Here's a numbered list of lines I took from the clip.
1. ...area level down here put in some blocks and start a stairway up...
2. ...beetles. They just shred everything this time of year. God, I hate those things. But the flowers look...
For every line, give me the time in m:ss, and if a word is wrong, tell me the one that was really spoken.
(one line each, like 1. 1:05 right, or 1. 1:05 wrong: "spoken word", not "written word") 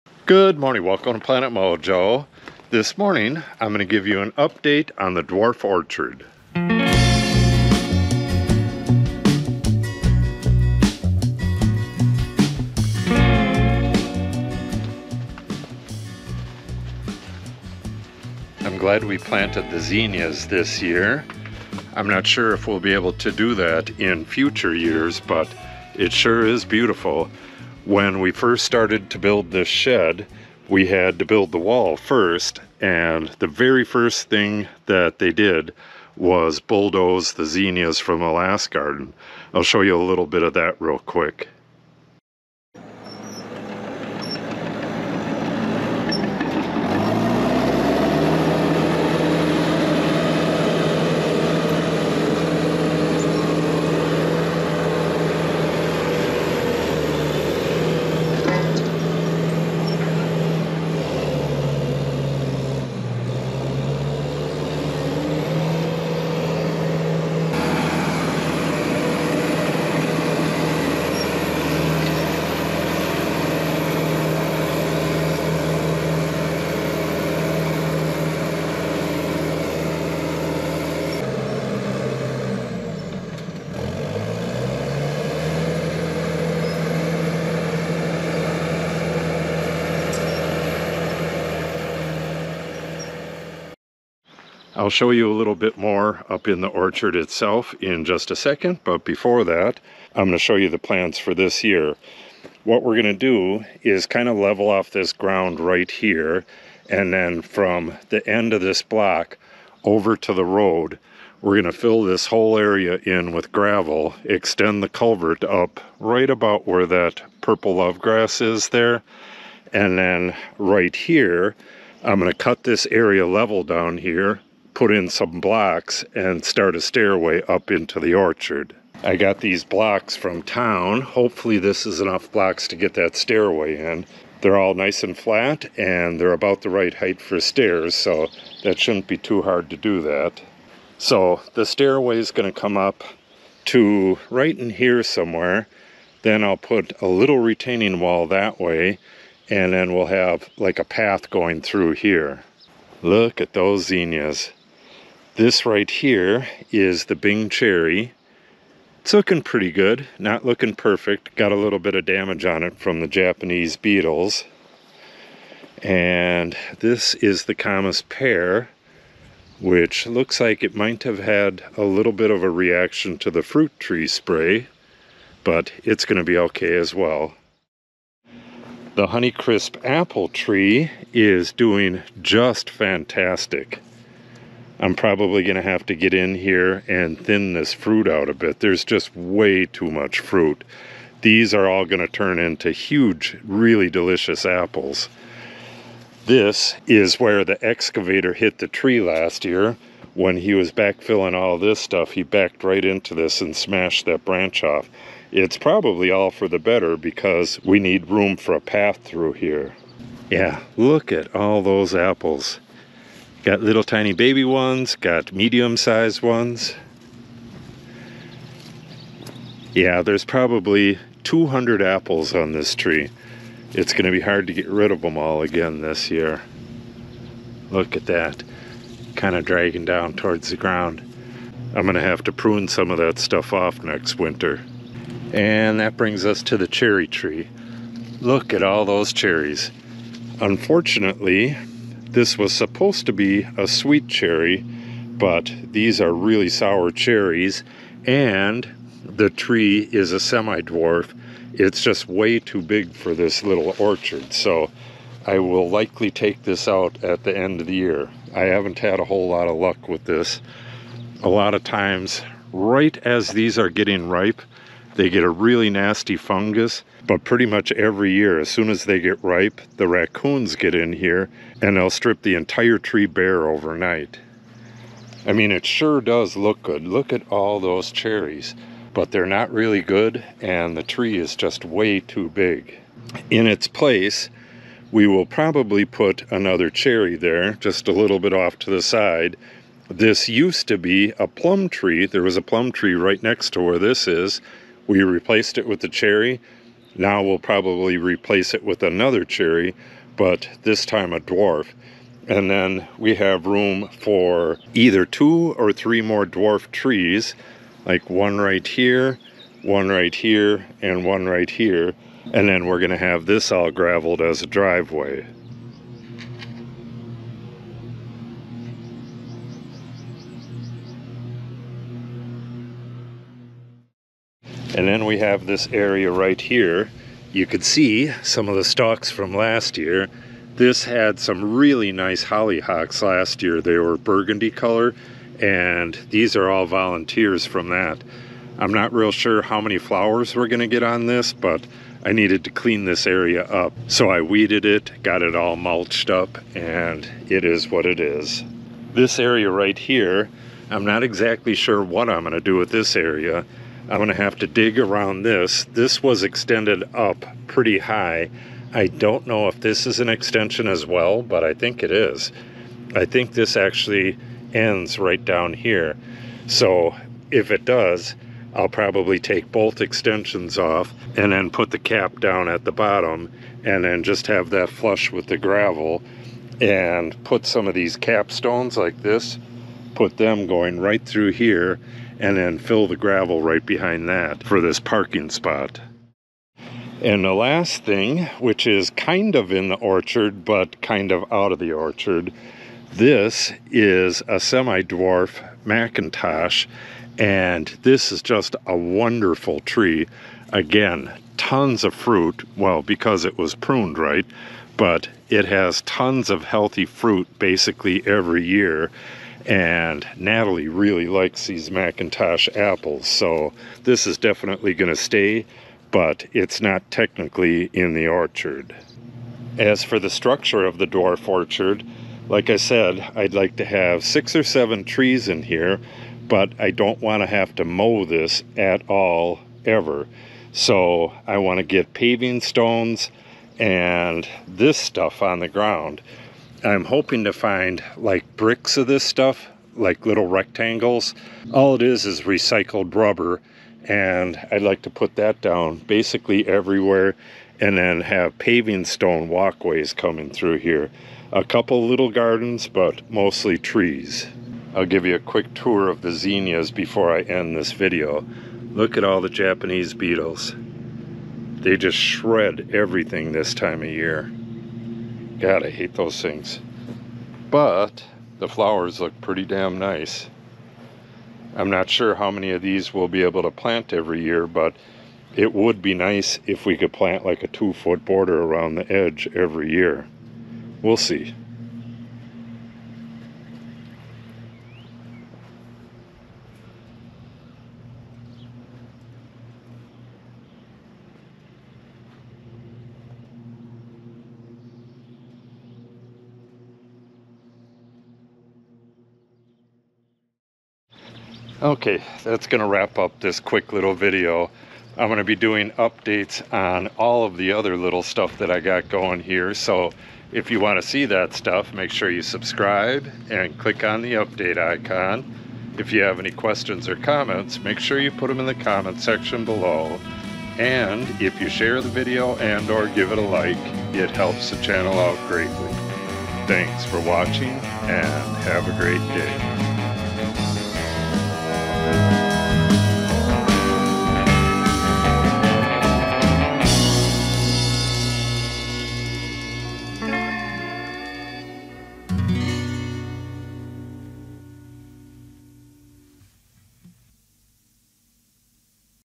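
1. 2:02 right
2. 7:39 right.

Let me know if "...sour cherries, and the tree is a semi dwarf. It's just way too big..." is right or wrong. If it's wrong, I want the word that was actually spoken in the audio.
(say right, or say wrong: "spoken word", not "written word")
right.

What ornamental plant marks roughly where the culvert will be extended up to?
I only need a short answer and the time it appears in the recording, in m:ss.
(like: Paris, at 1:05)
Purple love grass, at 1:57.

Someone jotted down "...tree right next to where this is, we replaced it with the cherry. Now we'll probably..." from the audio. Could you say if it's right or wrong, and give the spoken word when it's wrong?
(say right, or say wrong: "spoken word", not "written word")
right.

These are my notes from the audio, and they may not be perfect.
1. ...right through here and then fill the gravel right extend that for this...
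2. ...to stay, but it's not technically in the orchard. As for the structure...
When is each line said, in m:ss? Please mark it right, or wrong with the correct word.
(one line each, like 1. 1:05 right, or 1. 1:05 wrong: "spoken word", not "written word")
1. 6:20 wrong: "behind", not "extend"
2. 6:54 right.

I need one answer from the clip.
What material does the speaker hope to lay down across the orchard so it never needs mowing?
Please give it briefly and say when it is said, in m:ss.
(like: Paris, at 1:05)
Recycled rubber, at 7:22.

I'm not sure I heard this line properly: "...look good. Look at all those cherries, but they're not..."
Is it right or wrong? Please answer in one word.
right.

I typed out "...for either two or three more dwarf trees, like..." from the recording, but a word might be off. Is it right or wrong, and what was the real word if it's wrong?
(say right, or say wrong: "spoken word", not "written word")
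right.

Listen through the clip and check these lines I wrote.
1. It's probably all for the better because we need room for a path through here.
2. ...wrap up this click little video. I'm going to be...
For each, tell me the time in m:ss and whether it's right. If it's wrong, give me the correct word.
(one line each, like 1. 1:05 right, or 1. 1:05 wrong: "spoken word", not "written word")
1. 3:25 right
2. 8:22 wrong: "quick", not "click".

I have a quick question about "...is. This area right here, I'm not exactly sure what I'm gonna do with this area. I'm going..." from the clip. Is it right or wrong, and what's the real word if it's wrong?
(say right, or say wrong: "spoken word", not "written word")
right.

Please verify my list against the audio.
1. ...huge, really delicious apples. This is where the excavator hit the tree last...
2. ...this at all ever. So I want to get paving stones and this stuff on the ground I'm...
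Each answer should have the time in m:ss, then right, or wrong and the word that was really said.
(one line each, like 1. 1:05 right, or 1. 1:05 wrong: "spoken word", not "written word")
1. 3:12 right
2. 7:08 right.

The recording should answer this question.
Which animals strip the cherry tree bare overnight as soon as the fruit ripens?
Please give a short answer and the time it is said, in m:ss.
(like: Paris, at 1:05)
Raccoons, at 4:29.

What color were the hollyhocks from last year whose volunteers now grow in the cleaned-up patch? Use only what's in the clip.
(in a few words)
Burgundy.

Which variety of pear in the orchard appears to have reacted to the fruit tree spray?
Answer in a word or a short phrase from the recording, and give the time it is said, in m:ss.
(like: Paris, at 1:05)
Comice, at 2:47.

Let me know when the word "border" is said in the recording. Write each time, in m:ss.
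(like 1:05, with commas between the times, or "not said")
7:58.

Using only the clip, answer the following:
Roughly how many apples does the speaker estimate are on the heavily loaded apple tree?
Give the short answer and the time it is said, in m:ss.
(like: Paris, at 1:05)
200, at 3:41.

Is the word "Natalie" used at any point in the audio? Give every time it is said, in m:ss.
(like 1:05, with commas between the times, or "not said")
6:50.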